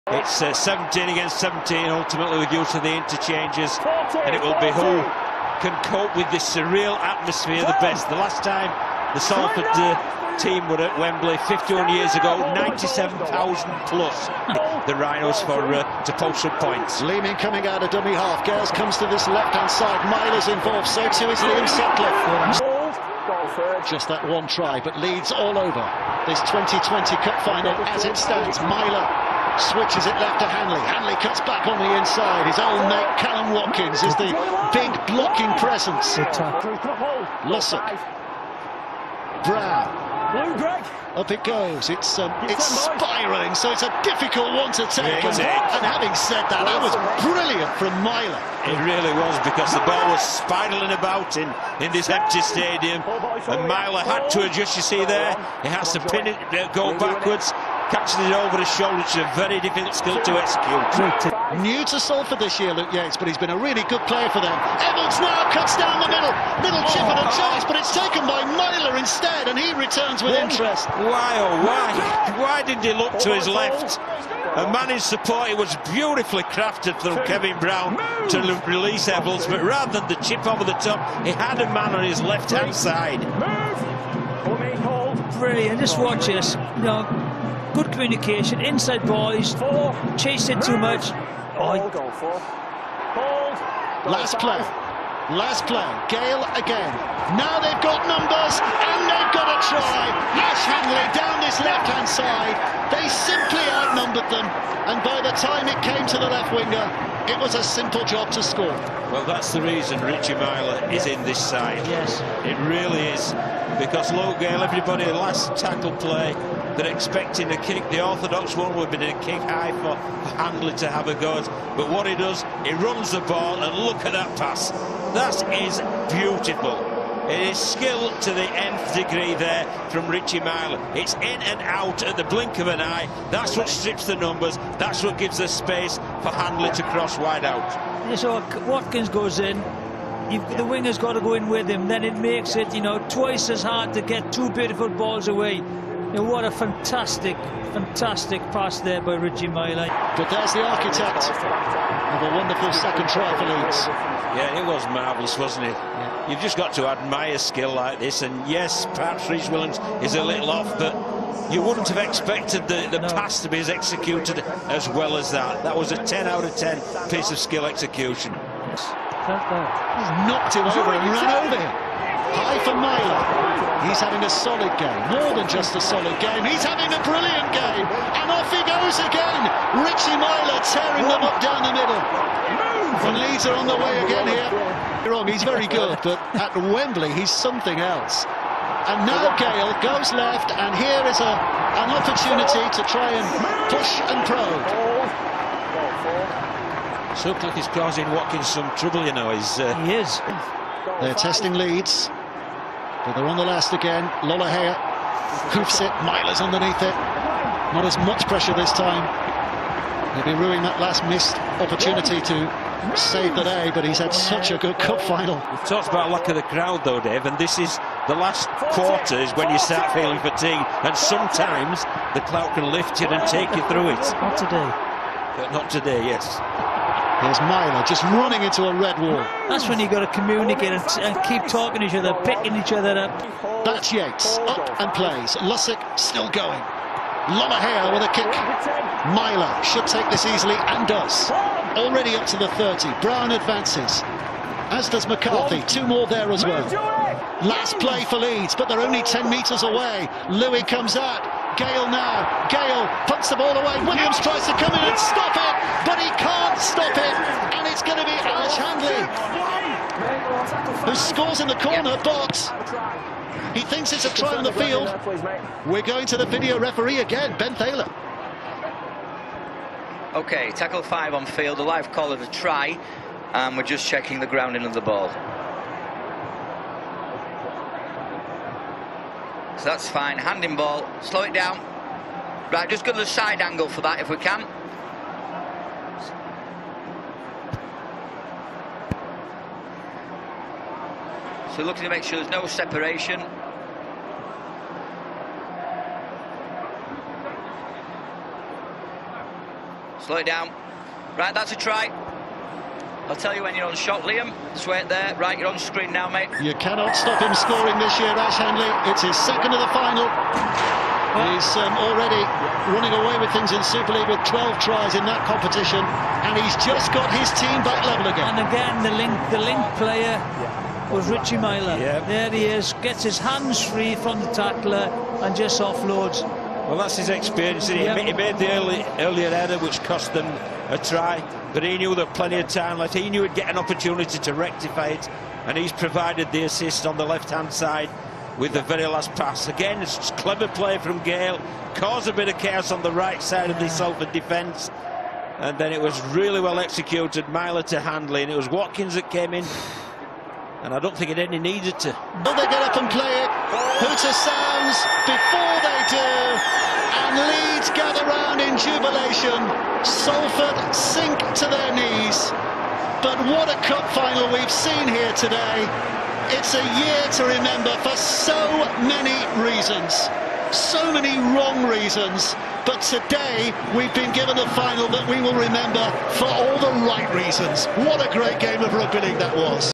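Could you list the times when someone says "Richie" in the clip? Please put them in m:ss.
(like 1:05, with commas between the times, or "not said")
1:50, 2:10, 2:29, 2:59, 5:21.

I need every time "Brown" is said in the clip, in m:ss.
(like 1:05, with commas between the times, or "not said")
0:39, 1:17, 4:02.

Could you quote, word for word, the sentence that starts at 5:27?
He, he made the early, earlier error, which cost them a try, but he knew there plenty of time left.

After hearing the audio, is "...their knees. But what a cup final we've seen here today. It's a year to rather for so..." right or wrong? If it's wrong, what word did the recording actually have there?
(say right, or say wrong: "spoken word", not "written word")
wrong: "remember", not "rather".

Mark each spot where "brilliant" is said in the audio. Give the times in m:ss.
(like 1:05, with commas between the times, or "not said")
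0:47, 1:25, 2:57.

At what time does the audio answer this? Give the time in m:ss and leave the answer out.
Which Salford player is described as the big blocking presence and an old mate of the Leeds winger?
0:33.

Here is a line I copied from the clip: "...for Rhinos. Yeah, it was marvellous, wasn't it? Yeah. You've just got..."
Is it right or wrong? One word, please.
wrong.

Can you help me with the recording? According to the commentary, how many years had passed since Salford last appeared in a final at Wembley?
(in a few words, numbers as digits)
51 years.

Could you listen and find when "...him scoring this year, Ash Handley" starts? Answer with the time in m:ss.
5:07.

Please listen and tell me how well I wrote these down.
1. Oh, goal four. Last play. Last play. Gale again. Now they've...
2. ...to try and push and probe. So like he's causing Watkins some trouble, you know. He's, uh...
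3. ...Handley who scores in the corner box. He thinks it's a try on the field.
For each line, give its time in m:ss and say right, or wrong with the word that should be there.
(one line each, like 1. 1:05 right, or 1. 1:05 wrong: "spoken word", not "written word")
1. 1:31 right
2. 3:12 right
3. 4:18 right.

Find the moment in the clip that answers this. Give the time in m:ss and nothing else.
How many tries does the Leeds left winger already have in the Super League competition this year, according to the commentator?
5:14.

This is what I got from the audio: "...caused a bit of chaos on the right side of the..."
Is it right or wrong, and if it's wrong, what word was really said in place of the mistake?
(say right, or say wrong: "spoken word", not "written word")
right.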